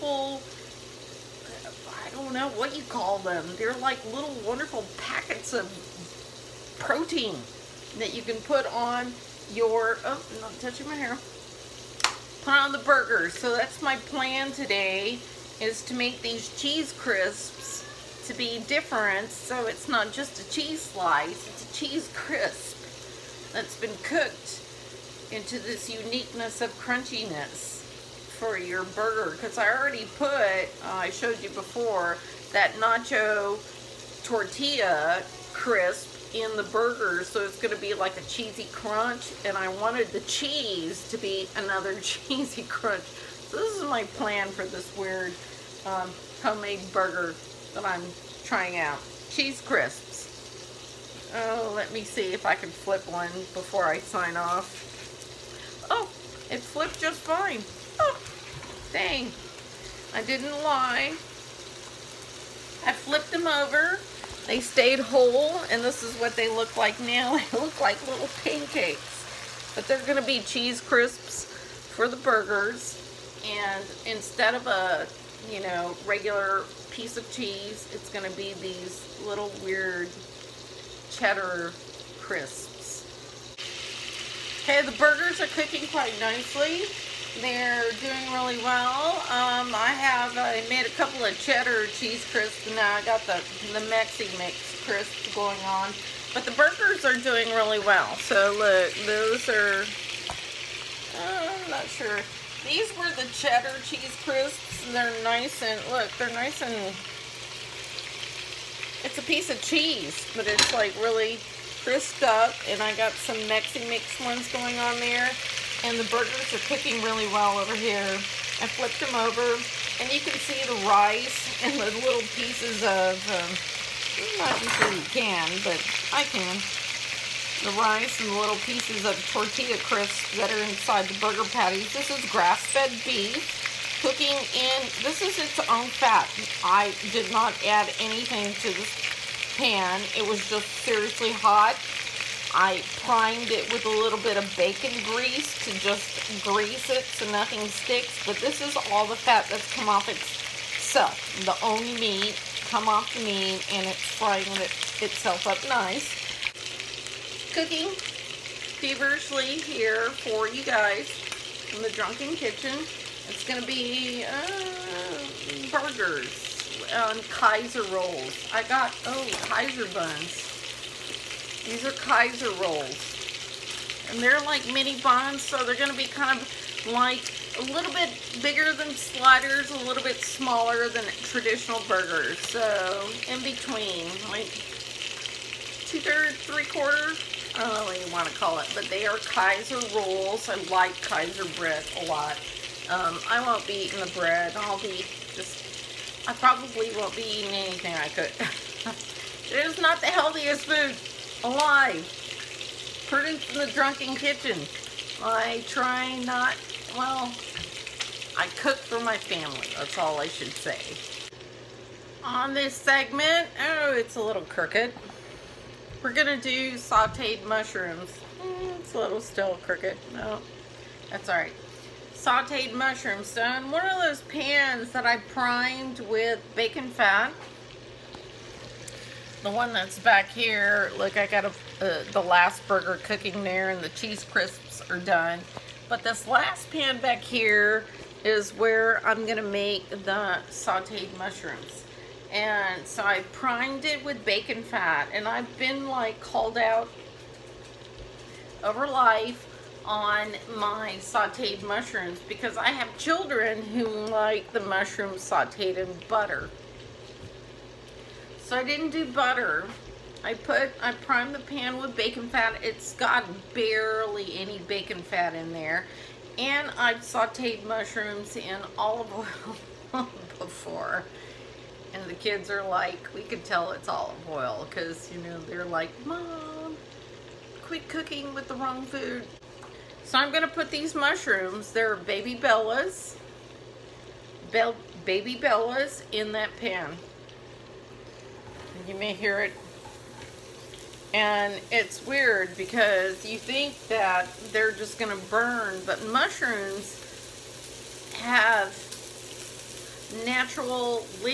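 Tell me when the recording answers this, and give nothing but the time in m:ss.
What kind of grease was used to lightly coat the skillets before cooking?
2:24.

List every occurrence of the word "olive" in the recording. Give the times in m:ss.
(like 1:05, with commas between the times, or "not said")
4:28, 4:33.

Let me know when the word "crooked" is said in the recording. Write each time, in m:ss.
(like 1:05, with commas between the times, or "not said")
3:34, 3:39.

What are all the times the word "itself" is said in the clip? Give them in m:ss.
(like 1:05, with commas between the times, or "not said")
2:30, 2:35.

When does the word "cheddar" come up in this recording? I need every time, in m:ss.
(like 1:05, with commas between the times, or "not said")
1:21, 1:31, 1:43.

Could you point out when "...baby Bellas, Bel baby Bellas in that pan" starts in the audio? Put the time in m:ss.
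4:41.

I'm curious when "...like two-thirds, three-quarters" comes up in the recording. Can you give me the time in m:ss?
3:04.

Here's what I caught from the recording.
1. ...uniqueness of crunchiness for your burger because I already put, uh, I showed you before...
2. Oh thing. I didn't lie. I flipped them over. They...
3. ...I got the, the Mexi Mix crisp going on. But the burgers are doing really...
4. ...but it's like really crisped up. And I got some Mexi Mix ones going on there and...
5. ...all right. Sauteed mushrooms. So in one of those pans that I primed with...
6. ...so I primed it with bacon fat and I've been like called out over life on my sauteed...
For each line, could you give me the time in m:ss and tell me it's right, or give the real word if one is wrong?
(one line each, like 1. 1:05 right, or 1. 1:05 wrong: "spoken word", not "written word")
1. 0:25 right
2. 0:57 right
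3. 1:32 right
4. 1:50 right
5. 3:41 right
6. 4:02 right.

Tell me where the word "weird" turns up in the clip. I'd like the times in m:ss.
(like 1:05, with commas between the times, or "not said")
0:44, 1:19, 4:52.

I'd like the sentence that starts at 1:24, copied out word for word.
Okay, the burgers are cooking quite nicely.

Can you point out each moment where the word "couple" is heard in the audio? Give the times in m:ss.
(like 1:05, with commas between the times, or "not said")
1:30.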